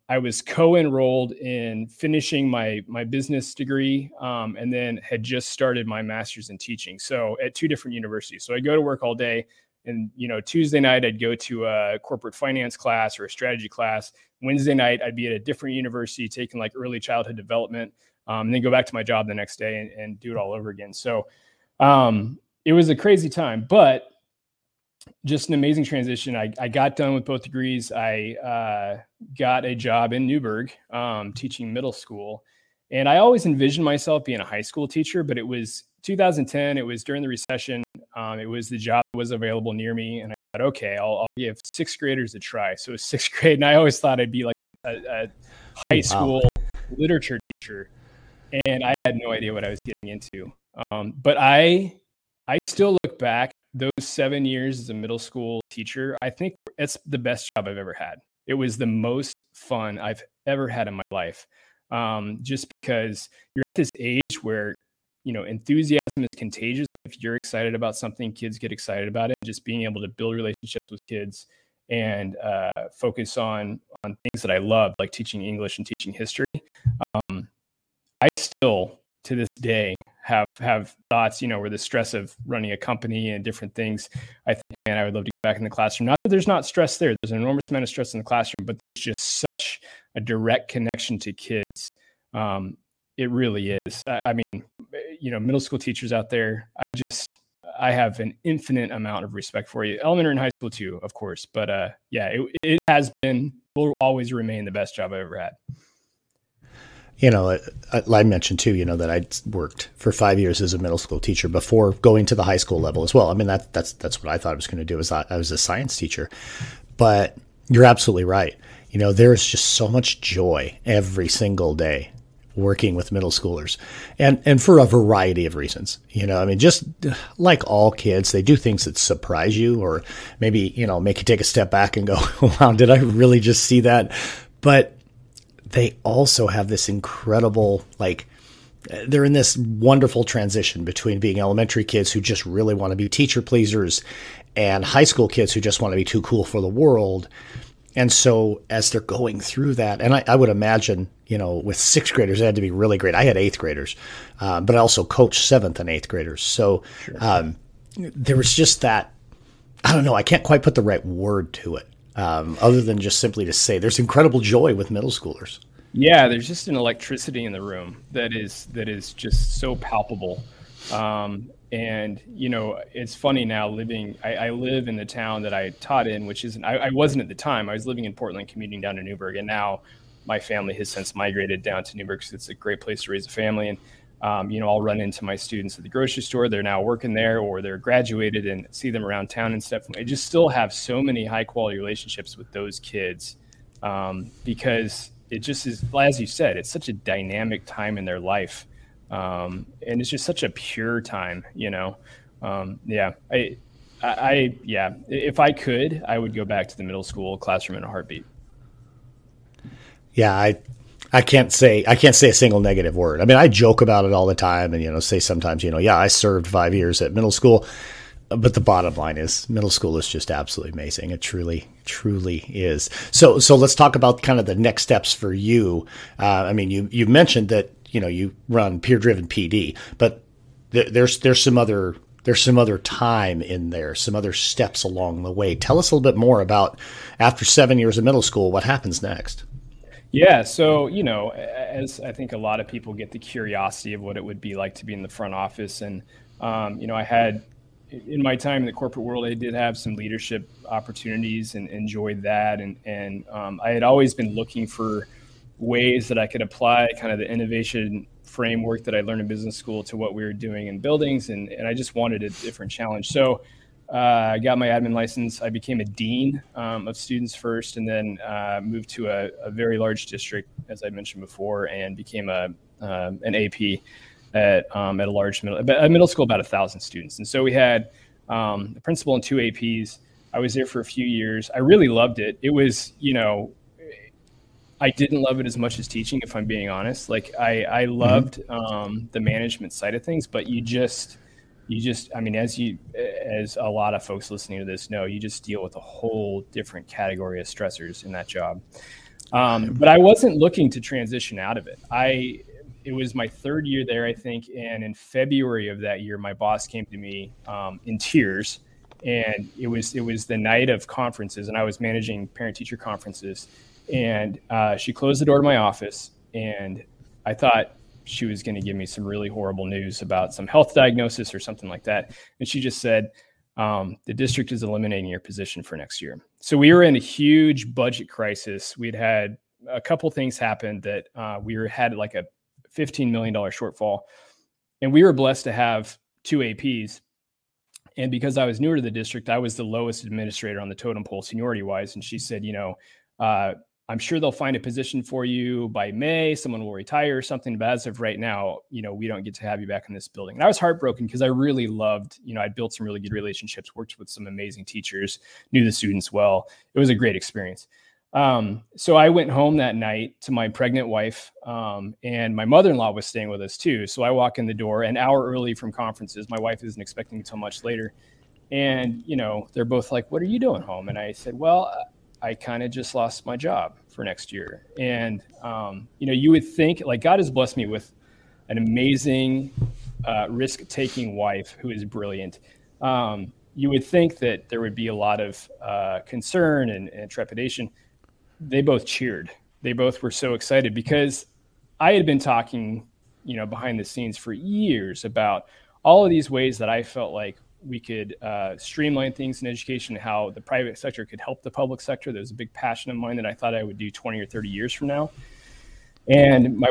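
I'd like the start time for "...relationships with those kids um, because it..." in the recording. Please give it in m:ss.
3:11.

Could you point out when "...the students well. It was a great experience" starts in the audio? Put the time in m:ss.
5:55.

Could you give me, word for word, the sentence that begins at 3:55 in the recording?
Tell us a little bit more about after seven years of middle school, what happens next.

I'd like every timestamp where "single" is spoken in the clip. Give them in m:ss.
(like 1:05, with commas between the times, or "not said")
2:01, 3:32.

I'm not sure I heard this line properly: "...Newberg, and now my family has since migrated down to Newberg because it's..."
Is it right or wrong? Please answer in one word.
right.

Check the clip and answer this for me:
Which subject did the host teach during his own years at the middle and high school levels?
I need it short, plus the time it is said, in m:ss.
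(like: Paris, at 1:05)
science, at 1:55.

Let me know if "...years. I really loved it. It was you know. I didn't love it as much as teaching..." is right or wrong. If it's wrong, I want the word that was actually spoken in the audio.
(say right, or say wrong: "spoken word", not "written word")
right.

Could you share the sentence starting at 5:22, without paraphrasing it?
And she just said, um, the district is eliminating your position for next year.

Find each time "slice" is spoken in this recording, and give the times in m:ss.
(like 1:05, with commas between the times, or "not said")
not said.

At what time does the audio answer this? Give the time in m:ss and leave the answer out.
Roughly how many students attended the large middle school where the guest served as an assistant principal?
4:36.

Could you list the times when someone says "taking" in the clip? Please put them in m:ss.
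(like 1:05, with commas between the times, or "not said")
0:16, 6:20.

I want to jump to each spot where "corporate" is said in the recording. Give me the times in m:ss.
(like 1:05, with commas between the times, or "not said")
0:12, 4:08.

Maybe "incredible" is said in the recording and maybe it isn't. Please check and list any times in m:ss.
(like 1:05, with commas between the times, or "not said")
2:16, 2:43.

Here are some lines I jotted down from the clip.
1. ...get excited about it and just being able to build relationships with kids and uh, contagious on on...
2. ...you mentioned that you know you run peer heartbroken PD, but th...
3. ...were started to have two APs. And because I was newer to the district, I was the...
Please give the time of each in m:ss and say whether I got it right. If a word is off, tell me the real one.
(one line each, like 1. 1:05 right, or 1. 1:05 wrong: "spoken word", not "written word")
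1. 1:08 wrong: "focus", not "contagious"
2. 3:46 wrong: "driven", not "heartbroken"
3. 5:35 wrong: "blessed", not "started".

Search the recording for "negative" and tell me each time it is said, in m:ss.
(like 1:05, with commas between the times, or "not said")
3:32.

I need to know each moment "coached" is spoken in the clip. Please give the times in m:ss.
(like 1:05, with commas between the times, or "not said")
2:35.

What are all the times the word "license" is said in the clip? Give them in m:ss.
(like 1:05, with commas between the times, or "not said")
4:24.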